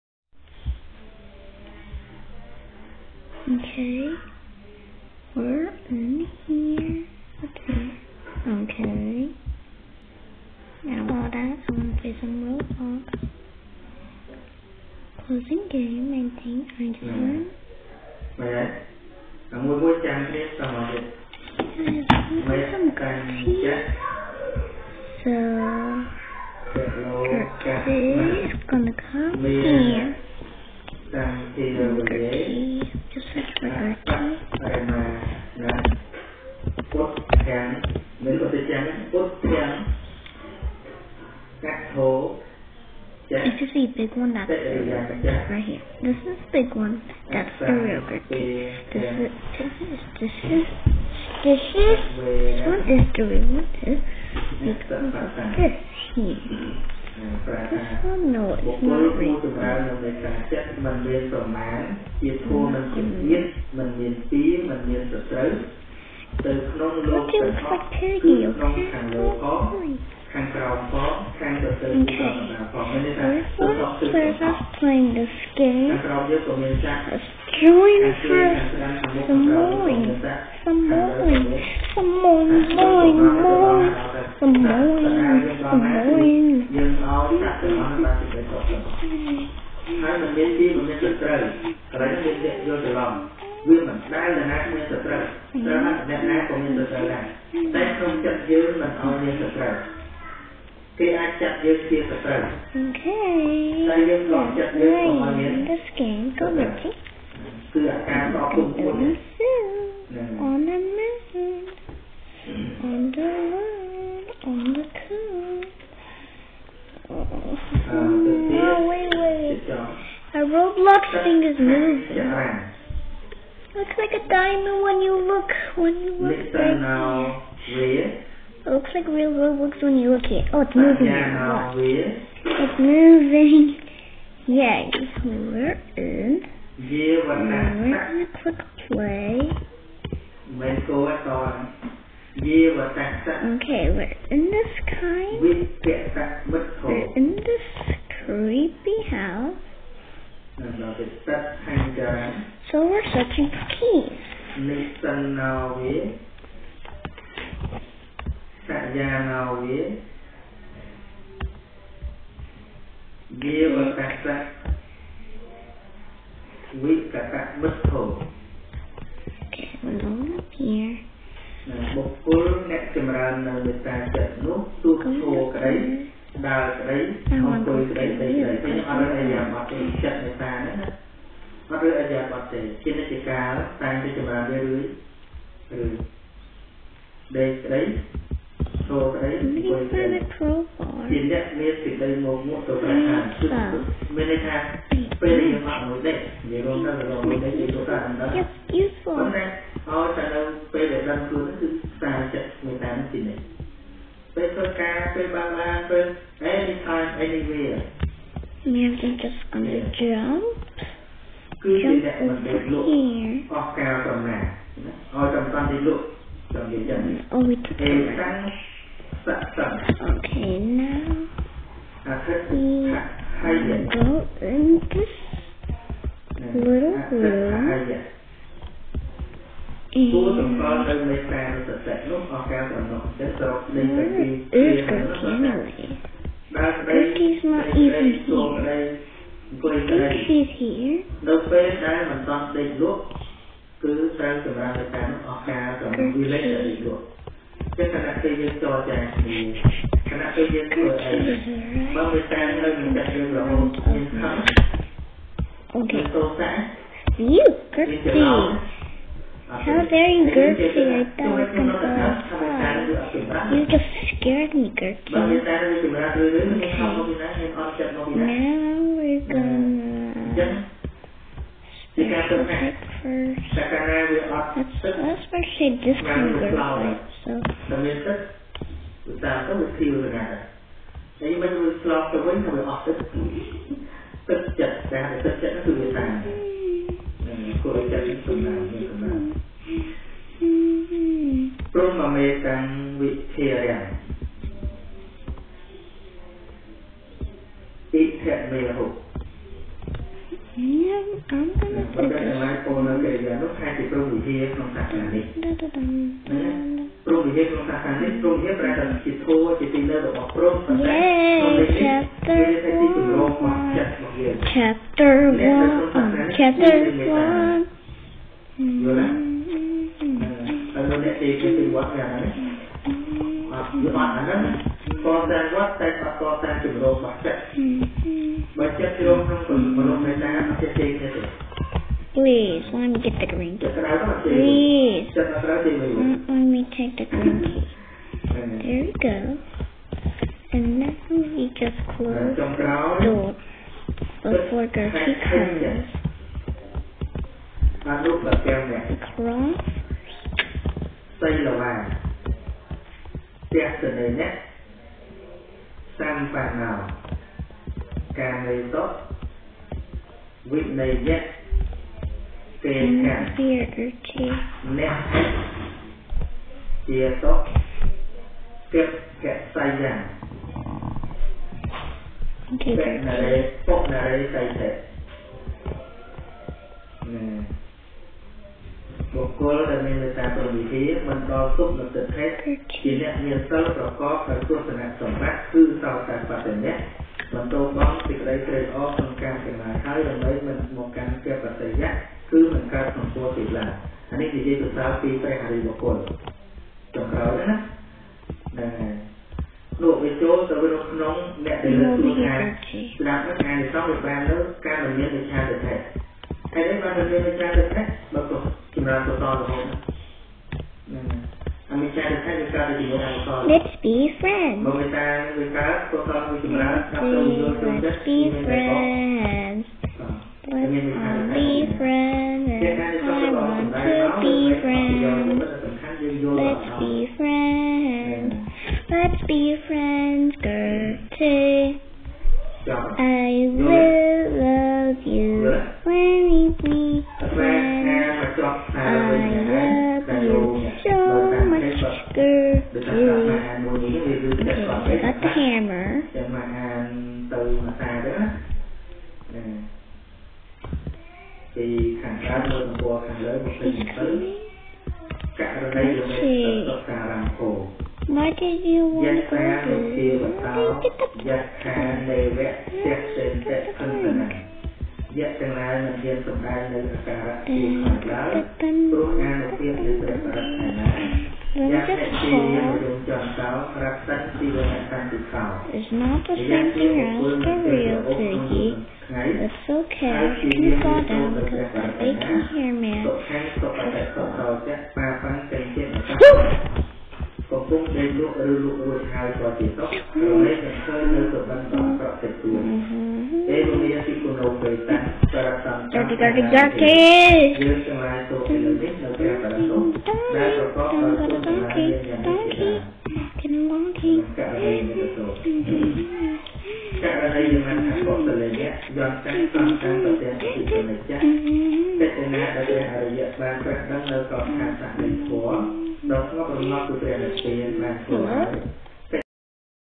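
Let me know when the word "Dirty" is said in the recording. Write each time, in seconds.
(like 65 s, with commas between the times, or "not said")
496 s.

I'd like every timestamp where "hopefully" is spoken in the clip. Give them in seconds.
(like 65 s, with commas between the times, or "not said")
not said.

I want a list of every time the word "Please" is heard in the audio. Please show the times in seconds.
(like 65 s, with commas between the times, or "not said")
328 s, 334 s.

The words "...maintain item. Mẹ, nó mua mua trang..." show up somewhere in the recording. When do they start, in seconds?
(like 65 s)
16 s.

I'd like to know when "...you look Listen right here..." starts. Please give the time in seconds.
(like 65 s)
126 s.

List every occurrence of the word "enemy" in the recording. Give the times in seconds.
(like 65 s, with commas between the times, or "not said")
not said.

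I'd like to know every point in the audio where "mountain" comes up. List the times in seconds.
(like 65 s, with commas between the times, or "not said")
110 s.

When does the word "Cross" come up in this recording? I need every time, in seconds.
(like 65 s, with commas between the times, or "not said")
349 s.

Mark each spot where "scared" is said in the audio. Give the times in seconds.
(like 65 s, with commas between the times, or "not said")
264 s.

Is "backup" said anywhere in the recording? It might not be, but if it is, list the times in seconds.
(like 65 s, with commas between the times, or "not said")
not said.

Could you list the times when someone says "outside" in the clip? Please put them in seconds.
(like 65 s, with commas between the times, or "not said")
261 s.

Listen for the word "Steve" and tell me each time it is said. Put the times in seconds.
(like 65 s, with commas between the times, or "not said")
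not said.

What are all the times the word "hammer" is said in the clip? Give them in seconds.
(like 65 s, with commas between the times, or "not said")
445 s.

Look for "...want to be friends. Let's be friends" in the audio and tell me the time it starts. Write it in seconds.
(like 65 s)
423 s.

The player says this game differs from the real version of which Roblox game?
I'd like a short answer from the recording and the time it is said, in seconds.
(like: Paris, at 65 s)
Piggy, at 478 s.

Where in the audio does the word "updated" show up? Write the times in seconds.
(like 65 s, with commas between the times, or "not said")
not said.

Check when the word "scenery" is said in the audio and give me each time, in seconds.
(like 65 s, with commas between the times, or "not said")
not said.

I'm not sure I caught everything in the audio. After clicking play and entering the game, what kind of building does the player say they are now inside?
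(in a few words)
creepy house.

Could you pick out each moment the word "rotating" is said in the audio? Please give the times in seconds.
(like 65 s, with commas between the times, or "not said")
not said.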